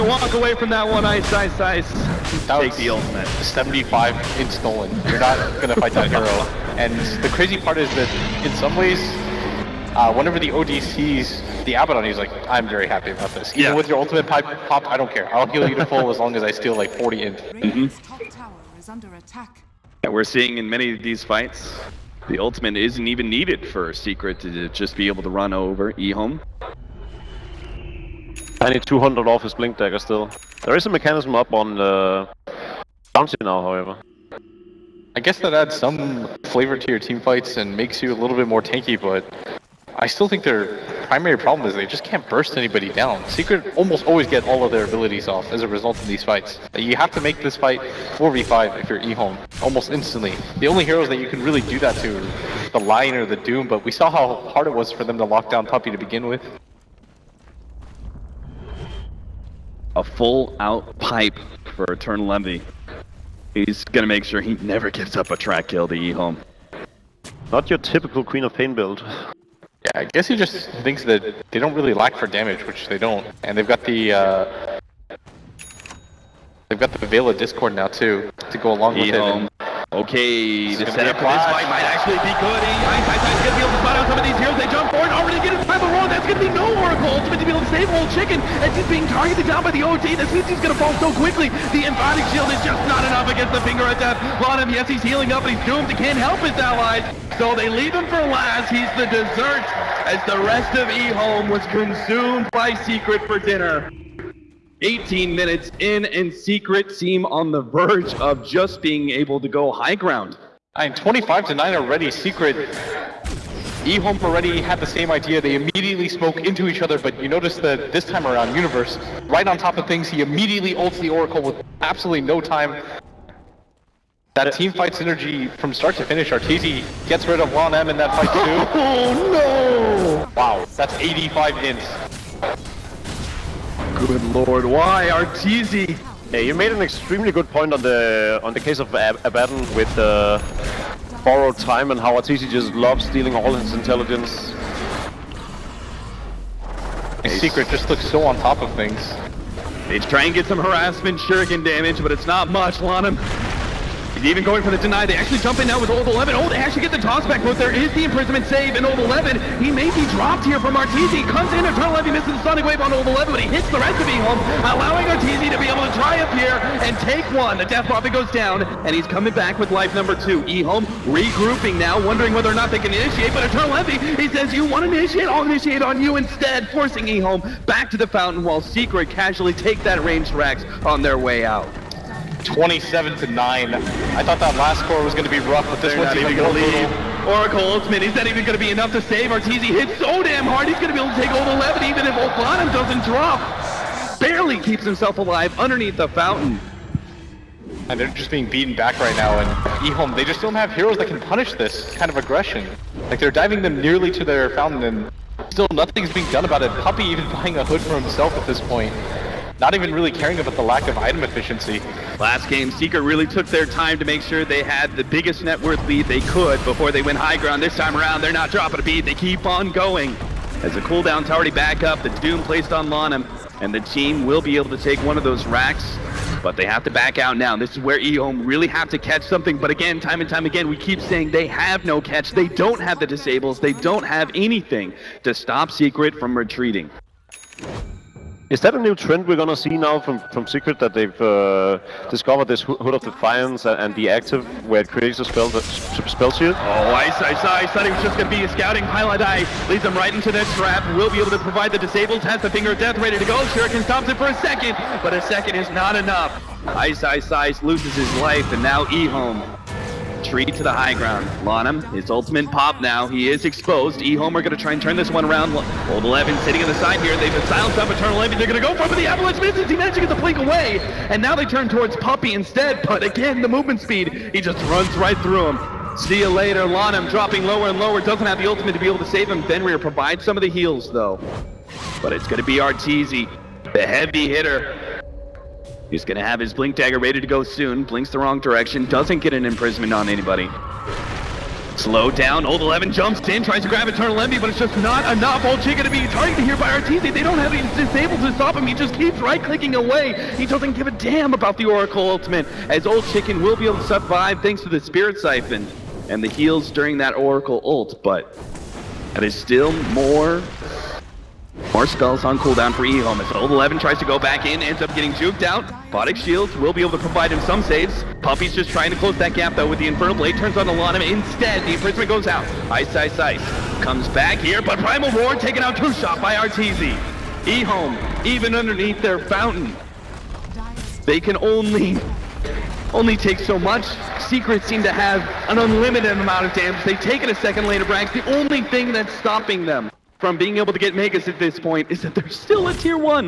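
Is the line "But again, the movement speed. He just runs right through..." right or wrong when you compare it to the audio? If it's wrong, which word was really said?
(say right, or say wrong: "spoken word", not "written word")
right.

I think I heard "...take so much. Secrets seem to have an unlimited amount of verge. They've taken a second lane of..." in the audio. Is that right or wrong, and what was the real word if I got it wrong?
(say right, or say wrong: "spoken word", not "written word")
wrong: "damage", not "verge".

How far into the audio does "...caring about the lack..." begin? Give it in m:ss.
3:30.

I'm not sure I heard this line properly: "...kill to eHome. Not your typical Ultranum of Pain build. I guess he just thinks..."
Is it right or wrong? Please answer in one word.
wrong.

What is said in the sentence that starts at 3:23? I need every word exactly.
Like, they're diving them nearly to their fountain, and still nothing's being done about it.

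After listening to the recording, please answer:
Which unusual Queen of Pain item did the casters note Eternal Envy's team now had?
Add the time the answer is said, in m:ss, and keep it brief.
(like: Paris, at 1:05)
Veil of Discord, at 1:17.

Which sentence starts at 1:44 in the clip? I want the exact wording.
18 minutes in and Secret seem on the verge of just being able to go high ground.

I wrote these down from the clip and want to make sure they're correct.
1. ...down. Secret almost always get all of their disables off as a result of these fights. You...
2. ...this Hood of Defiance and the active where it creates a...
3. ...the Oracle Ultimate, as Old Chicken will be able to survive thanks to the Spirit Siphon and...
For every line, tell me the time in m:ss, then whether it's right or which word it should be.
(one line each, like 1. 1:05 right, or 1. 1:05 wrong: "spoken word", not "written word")
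1. 0:42 wrong: "abilities", not "disables"
2. 4:02 right
3. 5:01 right.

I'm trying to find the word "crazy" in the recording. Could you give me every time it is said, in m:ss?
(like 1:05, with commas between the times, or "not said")
0:07.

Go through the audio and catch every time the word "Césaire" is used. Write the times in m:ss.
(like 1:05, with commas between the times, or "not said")
not said.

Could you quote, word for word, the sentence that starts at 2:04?
That team fight synergy from start to finish, Arteezy gets rid of Juan M in that fight too.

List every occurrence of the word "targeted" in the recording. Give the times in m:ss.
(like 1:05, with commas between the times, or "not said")
1:29, 4:56.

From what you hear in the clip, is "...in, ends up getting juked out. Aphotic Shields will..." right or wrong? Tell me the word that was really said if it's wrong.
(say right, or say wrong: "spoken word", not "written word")
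right.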